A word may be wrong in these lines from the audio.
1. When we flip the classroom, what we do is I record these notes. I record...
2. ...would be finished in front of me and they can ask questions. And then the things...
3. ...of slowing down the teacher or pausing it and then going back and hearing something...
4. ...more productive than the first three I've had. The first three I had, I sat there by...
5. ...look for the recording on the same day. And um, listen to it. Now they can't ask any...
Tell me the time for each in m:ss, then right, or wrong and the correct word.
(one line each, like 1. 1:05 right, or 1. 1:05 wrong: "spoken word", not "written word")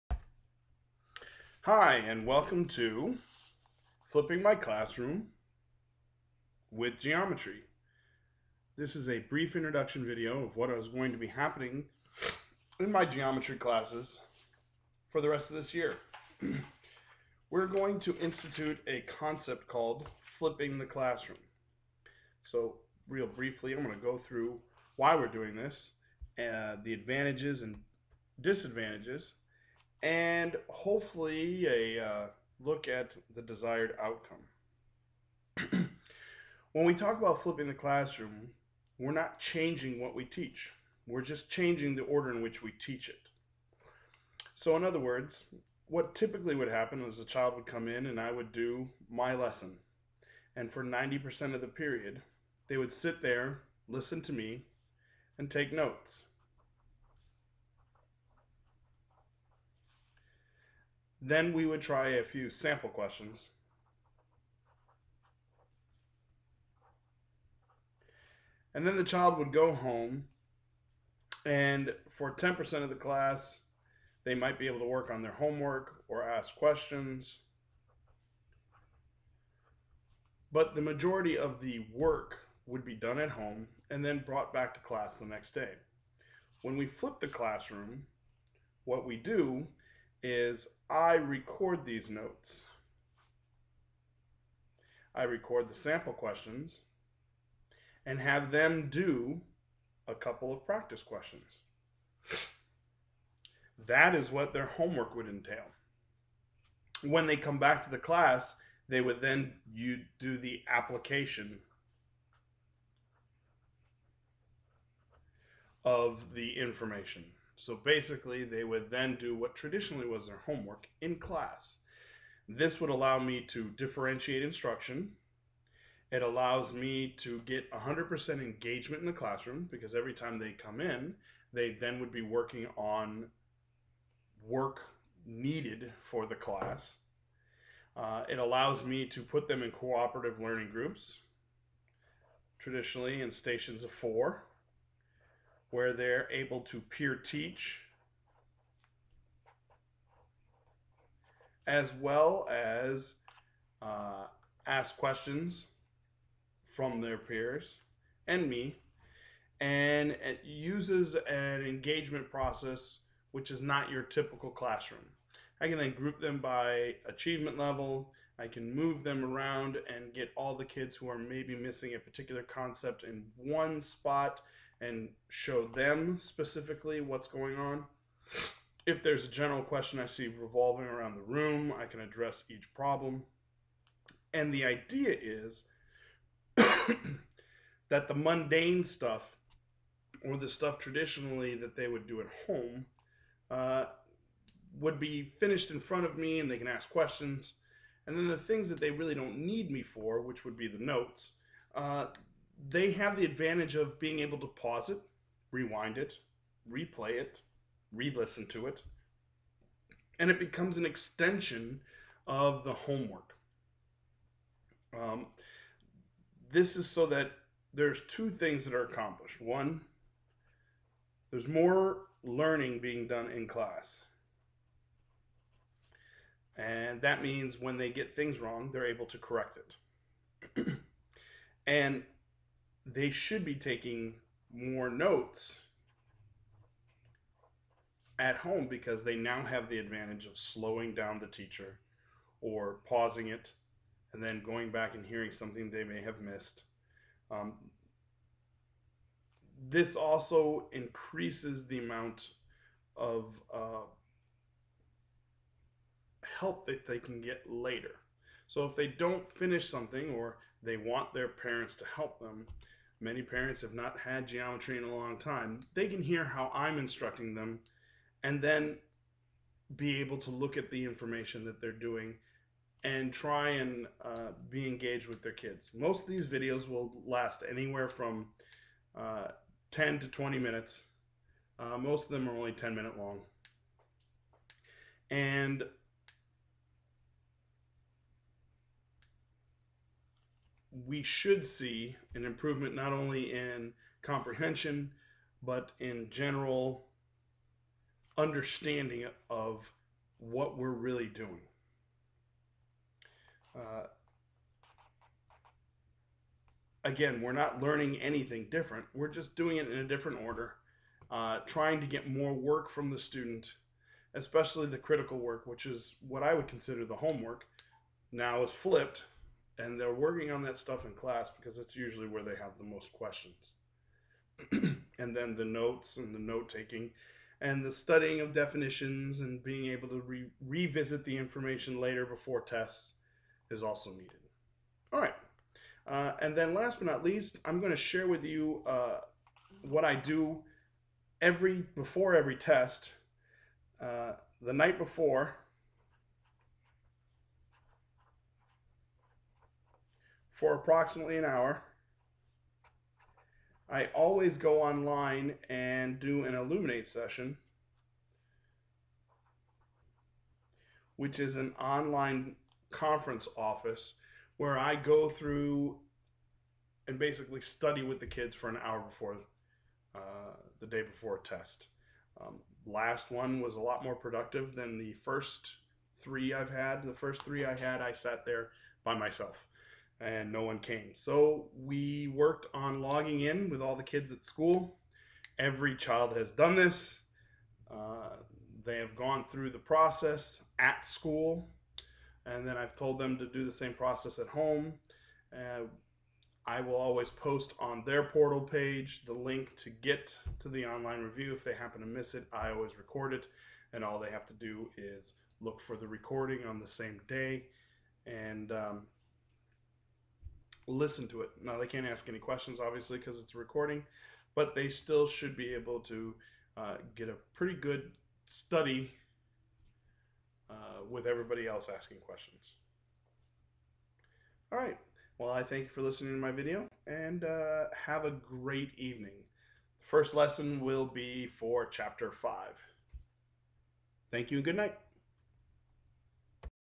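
1. 1:26 right
2. 3:14 right
3. 4:00 right
4. 6:13 right
5. 6:45 right.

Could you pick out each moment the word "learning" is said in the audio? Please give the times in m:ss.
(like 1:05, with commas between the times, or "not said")
2:20, 3:42, 5:07.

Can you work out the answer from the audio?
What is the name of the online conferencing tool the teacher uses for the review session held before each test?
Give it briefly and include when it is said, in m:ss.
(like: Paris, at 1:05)
Elluminate, at 5:56.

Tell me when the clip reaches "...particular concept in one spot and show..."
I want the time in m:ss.
2:51.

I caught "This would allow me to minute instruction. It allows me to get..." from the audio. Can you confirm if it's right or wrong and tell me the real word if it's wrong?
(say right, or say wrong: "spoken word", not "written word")
wrong: "differentiate", not "minute".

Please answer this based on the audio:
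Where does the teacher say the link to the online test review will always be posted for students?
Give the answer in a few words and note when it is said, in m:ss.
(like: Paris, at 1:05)
portal page, at 6:38.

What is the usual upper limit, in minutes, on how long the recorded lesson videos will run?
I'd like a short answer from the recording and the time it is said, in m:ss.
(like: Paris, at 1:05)
20 minutes, at 4:40.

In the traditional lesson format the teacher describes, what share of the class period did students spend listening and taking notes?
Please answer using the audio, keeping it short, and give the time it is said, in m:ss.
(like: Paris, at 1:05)
90%, at 0:50.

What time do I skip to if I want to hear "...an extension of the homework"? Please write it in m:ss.
3:30.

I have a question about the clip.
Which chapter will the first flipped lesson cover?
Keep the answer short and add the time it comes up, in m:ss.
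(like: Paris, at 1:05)
Chapter 5, at 7:11.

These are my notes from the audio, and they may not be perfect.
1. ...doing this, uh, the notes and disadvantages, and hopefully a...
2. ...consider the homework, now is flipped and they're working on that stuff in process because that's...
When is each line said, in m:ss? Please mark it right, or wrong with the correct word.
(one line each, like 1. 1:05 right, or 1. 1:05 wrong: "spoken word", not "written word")
1. 0:25 wrong: "advantages", not "notes"
2. 5:16 wrong: "class", not "process".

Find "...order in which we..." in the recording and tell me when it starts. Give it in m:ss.
0:42.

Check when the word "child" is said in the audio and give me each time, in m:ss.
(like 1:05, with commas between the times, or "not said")
0:47, 1:09, 6:25.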